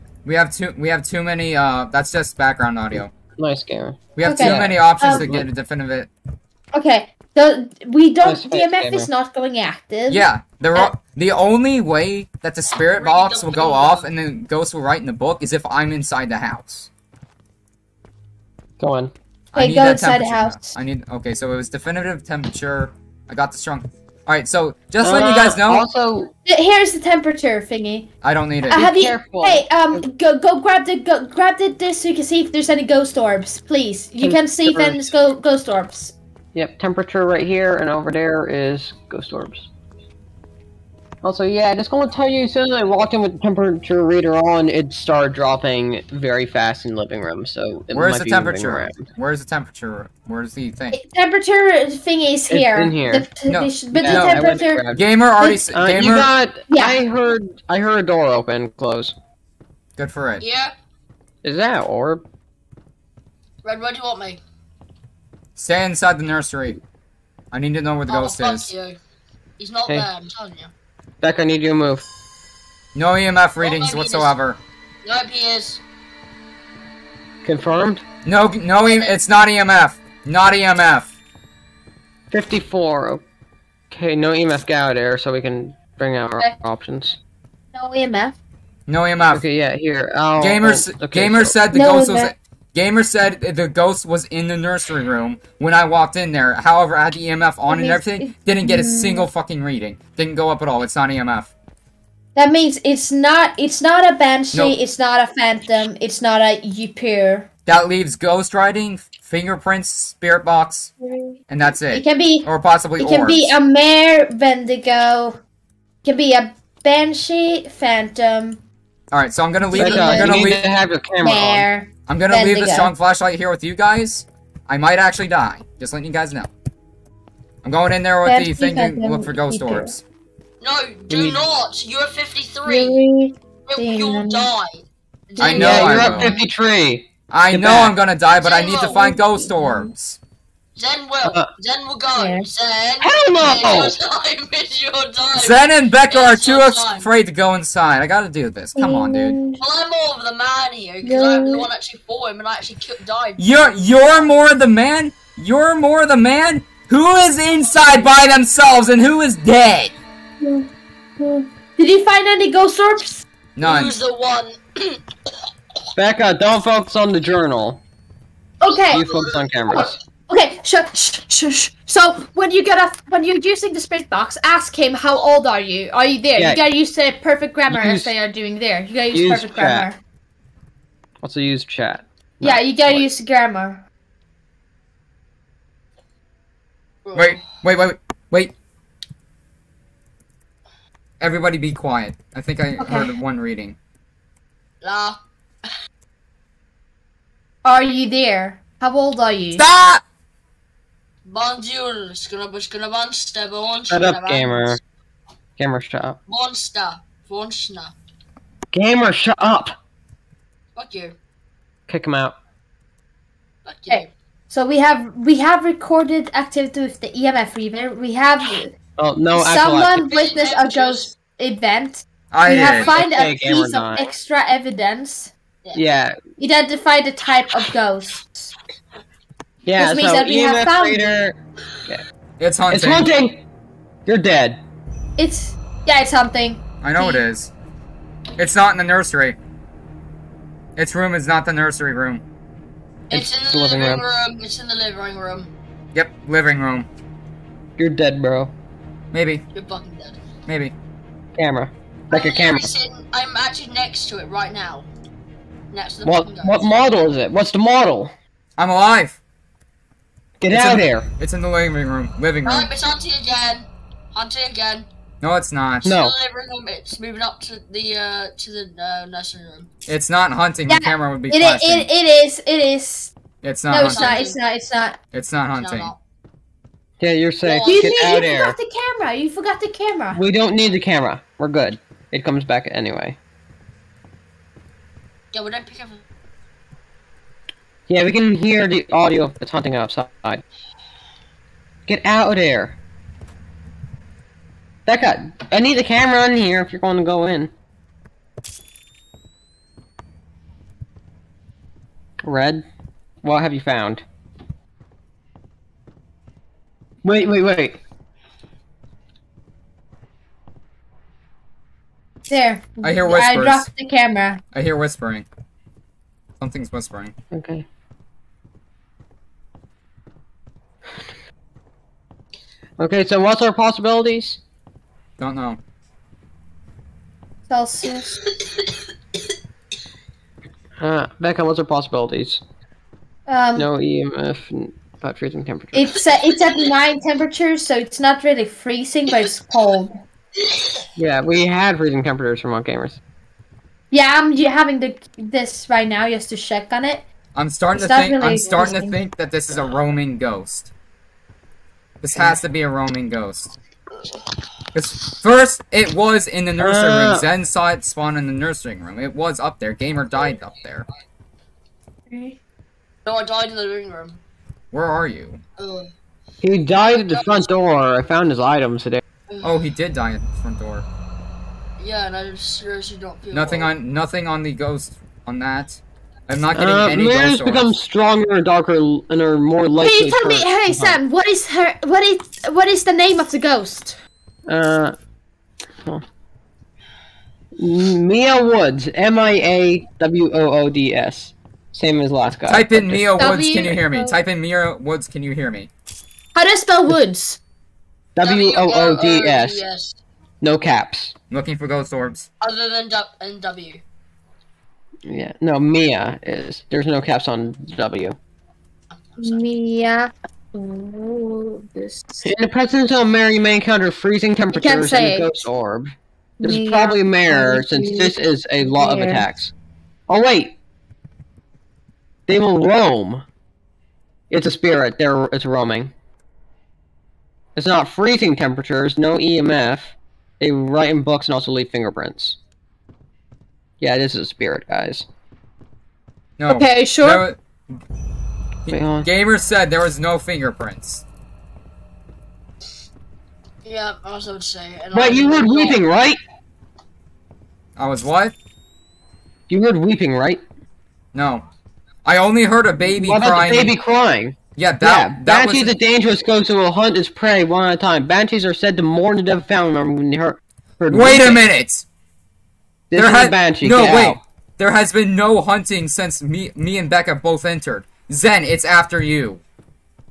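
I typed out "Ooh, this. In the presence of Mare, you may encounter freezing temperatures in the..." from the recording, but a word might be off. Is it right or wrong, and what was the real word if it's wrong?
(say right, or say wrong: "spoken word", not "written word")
right.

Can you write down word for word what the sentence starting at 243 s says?
It's, it's in the, the living room.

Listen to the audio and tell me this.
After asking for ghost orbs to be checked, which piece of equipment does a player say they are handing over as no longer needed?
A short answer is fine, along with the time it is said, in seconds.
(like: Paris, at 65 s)
The temperature reader, at 26 s.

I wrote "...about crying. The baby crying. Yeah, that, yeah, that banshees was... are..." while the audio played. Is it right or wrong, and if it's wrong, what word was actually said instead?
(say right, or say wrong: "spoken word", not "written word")
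right.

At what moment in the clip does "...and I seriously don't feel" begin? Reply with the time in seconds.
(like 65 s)
372 s.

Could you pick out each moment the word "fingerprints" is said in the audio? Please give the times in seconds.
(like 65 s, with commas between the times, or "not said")
109 s, 431 s, 440 s.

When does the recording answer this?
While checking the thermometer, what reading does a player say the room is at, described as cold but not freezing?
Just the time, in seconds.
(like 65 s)
336 s.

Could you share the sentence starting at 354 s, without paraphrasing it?
Because first, it was in the nursery uh.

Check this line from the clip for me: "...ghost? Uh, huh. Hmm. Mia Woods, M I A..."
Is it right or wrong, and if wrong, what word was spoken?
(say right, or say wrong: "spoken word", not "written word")
right.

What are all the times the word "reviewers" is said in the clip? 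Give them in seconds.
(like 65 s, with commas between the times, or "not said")
not said.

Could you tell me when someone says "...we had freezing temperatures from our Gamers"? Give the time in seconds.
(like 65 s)
341 s.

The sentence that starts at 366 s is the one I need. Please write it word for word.
he died at the front door.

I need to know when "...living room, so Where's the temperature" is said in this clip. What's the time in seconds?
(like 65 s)
46 s.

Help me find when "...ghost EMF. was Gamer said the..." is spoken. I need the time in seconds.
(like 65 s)
91 s.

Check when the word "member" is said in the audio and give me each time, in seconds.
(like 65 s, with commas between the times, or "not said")
459 s.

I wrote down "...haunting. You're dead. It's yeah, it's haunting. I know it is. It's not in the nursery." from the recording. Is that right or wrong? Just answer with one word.
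right.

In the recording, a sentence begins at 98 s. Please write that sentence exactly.
Didn't get a single fucking reading.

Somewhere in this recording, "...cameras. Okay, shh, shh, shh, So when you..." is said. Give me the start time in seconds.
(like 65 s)
169 s.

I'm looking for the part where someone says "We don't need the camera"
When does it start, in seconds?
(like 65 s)
280 s.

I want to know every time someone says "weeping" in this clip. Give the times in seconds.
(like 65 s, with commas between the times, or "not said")
445 s, 449 s, 460 s.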